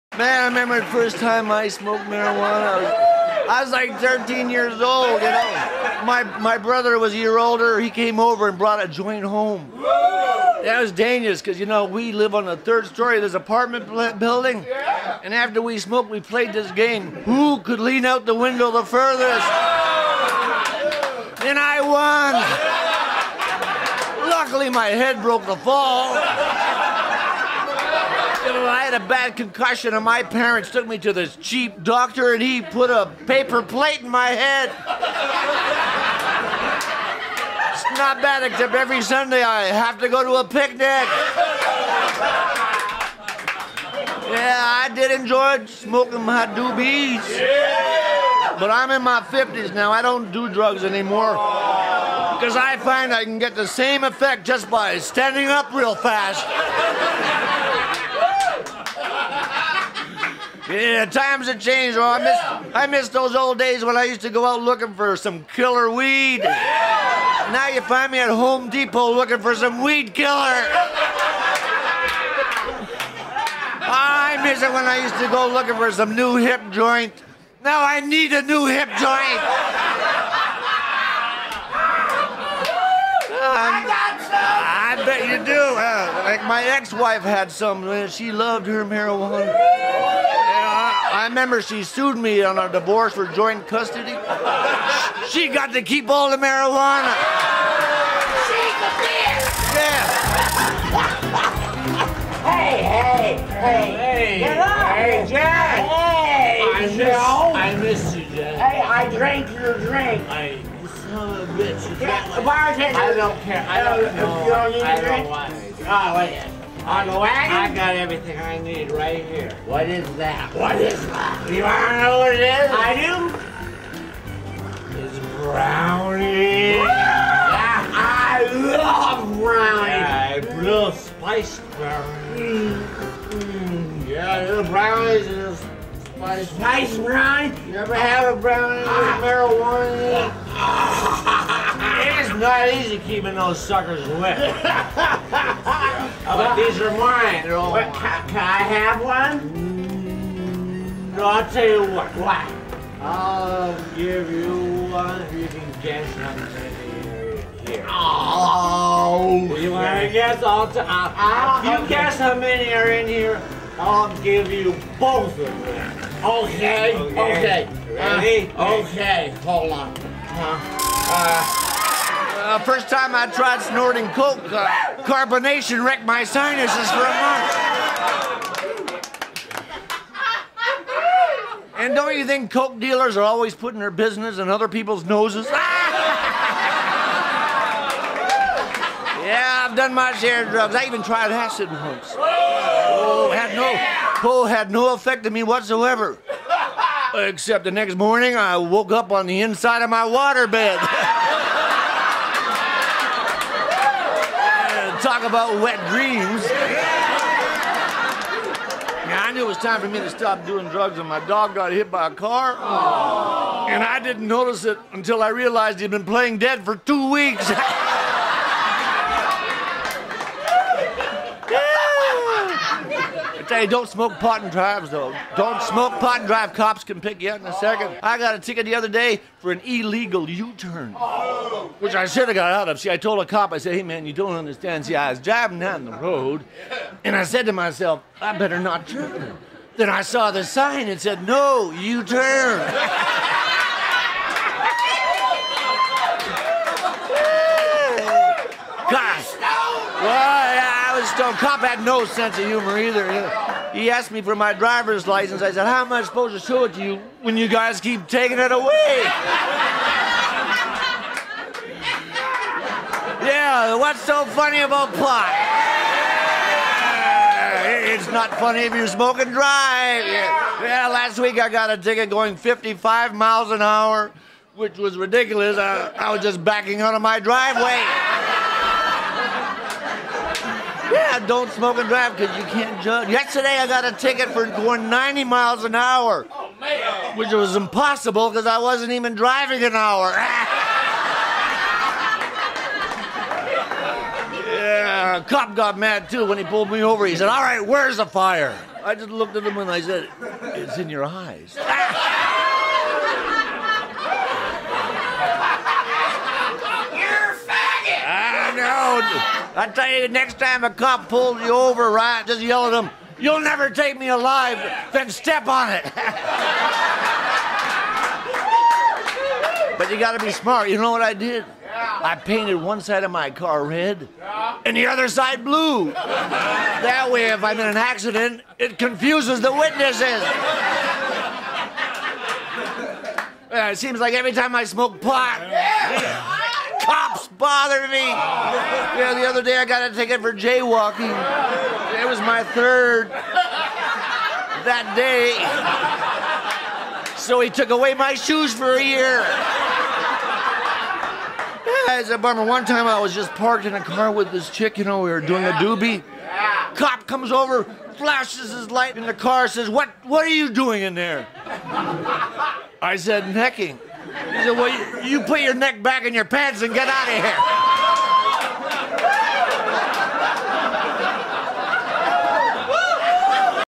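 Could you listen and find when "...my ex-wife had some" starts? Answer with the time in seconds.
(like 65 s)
86 s.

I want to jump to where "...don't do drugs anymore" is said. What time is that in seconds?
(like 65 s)
50 s.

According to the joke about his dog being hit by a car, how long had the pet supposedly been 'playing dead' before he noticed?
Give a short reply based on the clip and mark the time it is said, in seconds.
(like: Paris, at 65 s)
2 weeks, at 216 s.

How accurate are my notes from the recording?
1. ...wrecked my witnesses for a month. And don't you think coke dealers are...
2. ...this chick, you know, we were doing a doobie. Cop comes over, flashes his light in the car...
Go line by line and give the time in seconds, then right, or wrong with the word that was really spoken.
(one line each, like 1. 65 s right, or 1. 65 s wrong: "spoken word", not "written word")
1. 175 s wrong: "sinuses", not "witnesses"
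2. 354 s right.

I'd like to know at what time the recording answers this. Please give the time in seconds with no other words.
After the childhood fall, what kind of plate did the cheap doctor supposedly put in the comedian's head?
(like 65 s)
33 s.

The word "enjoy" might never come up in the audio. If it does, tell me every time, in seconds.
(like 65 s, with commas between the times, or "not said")
45 s.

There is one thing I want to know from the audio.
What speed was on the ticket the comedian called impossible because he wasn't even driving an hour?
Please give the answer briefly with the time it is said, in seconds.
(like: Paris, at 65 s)
90 miles an hour, at 284 s.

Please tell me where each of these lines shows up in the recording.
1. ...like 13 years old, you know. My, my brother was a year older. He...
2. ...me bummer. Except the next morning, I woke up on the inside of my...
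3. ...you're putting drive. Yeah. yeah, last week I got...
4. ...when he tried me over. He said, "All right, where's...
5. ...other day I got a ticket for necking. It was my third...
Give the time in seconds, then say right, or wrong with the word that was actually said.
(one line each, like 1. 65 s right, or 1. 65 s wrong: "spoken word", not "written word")
1. 3 s right
2. 195 s wrong: "whatsoever", not "bummer"
3. 268 s wrong: "smoking", not "putting"
4. 296 s wrong: "pulled", not "tried"
5. 339 s wrong: "jaywalking", not "necking".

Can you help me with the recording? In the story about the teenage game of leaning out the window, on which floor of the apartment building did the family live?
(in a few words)
third story.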